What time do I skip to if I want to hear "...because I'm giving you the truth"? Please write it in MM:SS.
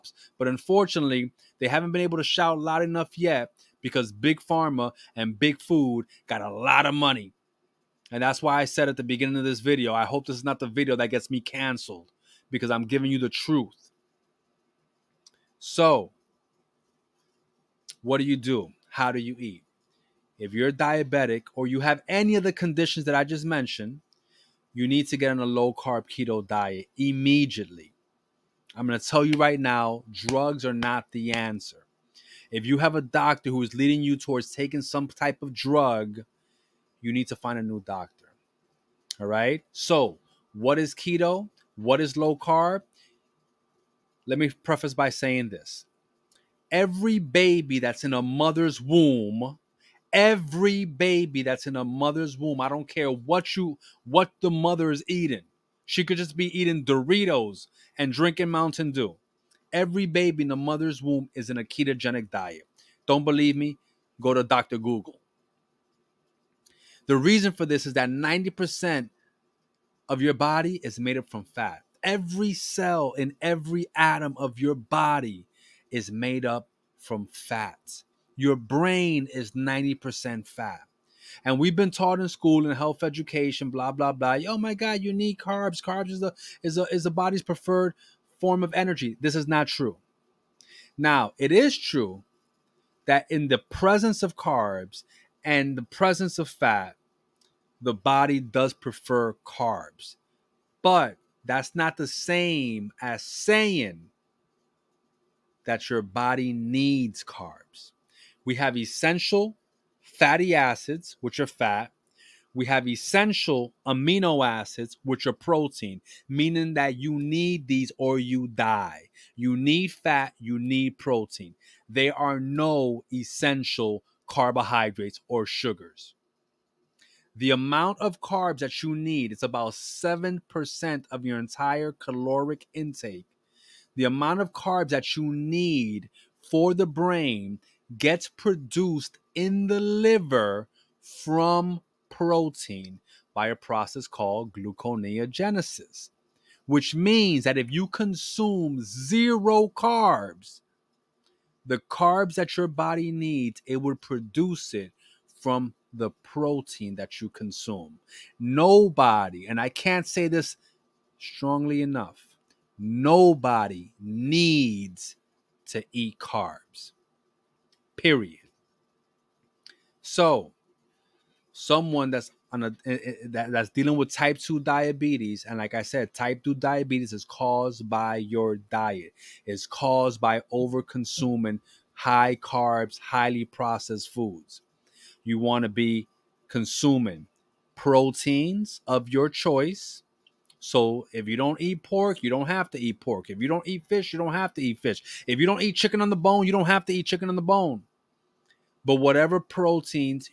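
00:12.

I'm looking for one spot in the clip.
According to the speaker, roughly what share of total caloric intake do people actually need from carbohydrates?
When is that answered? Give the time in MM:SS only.
02:09.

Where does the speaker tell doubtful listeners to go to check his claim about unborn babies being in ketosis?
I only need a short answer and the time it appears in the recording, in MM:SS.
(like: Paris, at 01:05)
Dr. Google, at 01:04.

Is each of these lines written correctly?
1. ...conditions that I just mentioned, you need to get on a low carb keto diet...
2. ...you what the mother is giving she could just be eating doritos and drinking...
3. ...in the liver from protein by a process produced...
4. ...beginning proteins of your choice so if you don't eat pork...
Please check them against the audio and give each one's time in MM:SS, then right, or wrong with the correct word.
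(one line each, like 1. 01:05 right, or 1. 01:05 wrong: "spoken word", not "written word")
1. 00:22 right
2. 00:53 wrong: "eating", not "giving"
3. 02:19 wrong: "called", not "produced"
4. 03:06 wrong: "consuming", not "beginning".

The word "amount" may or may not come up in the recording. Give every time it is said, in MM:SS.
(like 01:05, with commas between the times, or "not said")
02:07, 02:14.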